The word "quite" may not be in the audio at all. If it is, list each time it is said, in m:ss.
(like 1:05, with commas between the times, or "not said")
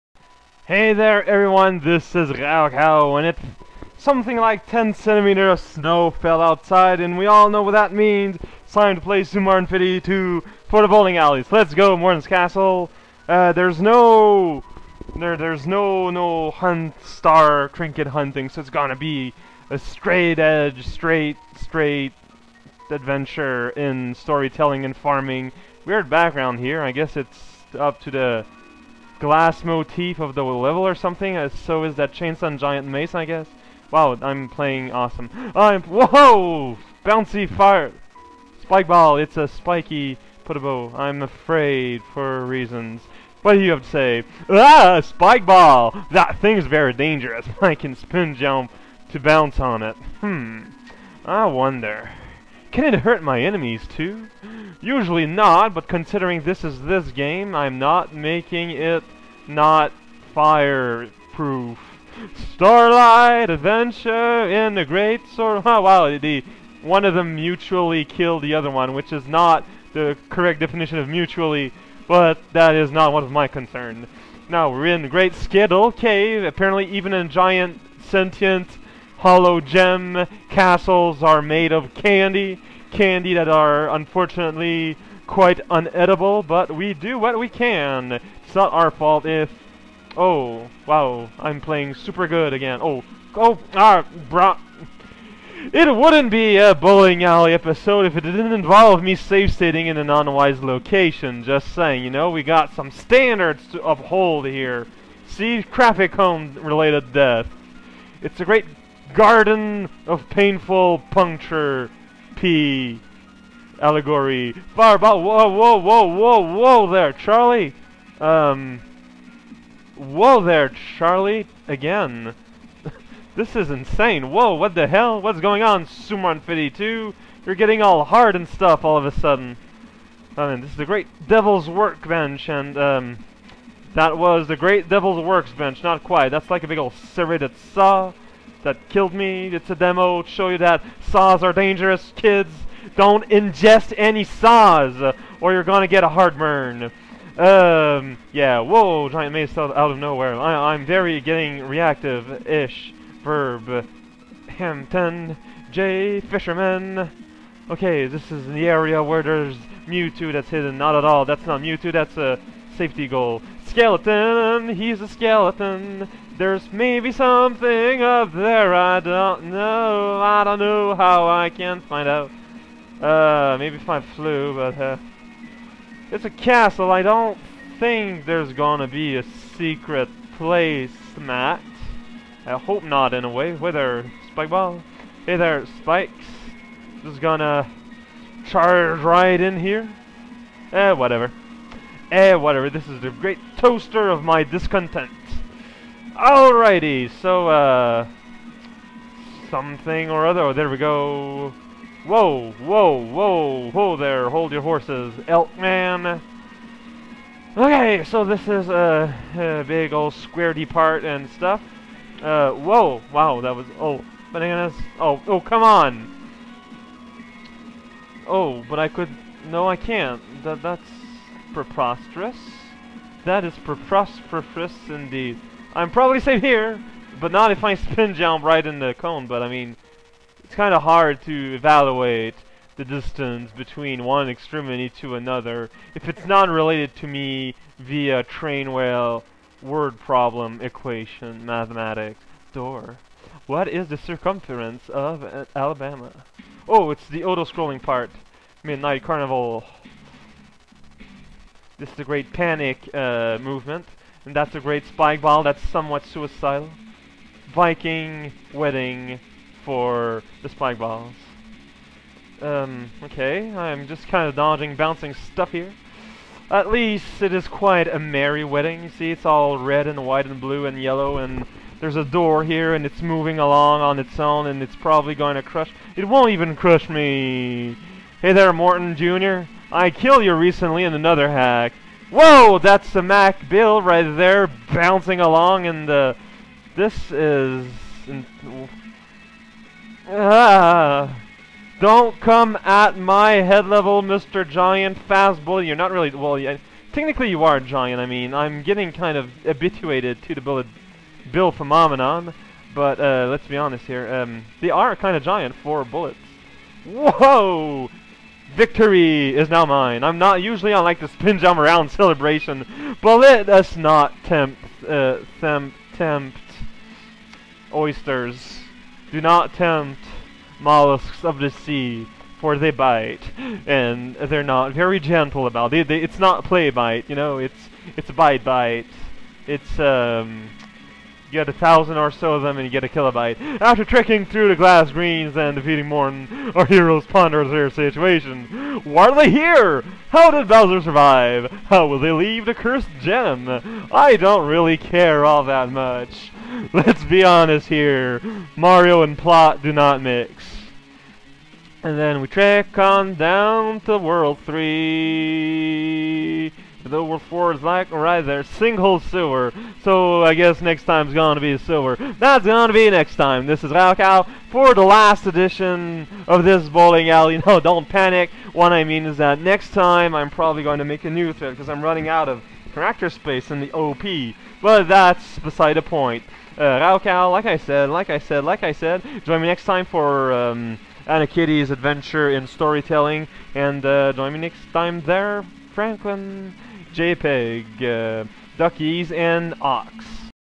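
1:25, 2:16, 4:27.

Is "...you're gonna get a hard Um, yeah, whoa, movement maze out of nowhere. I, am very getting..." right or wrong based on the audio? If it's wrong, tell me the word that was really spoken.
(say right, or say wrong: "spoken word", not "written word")
wrong: "giant", not "movement".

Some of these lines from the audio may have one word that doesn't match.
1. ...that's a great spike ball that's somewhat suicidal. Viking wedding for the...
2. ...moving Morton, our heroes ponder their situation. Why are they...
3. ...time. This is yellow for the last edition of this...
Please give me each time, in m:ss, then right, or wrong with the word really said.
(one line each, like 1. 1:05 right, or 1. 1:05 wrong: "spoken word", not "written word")
1. 4:14 right
2. 5:35 wrong: "defeating", not "moving"
3. 6:03 wrong: "raocow", not "yellow".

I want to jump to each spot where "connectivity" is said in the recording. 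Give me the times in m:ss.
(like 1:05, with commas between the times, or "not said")
not said.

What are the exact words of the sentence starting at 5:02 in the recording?
But uh, let's be honest here.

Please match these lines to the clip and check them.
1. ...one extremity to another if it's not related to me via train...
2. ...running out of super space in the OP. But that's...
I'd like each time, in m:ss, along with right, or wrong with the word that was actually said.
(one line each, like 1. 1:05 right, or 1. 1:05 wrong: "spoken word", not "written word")
1. 3:54 right
2. 6:11 wrong: "character", not "super".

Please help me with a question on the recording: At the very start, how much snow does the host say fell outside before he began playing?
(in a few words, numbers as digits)
10 centimeters.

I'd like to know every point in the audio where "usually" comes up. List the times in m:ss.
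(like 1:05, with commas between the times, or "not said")
0:54, 5:10.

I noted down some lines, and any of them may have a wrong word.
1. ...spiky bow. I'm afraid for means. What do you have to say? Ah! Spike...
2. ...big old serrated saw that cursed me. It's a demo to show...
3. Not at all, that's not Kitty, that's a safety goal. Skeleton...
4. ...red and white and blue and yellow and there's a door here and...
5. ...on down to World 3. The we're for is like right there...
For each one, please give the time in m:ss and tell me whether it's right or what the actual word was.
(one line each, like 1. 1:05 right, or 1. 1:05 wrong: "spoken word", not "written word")
1. 0:39 wrong: "reasons", not "means"
2. 2:16 wrong: "killed", not "cursed"
3. 2:40 wrong: "Mewtwo", not "Kitty"
4. 4:29 right
5. 5:52 right.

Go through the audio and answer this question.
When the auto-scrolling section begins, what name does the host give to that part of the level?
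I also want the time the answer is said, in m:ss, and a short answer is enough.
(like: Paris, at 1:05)
Midnight Carnival, at 4:08.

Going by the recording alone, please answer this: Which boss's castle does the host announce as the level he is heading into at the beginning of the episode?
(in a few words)
Morton's Castle.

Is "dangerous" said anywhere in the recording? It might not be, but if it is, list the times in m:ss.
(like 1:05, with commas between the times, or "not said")
0:46, 2:21.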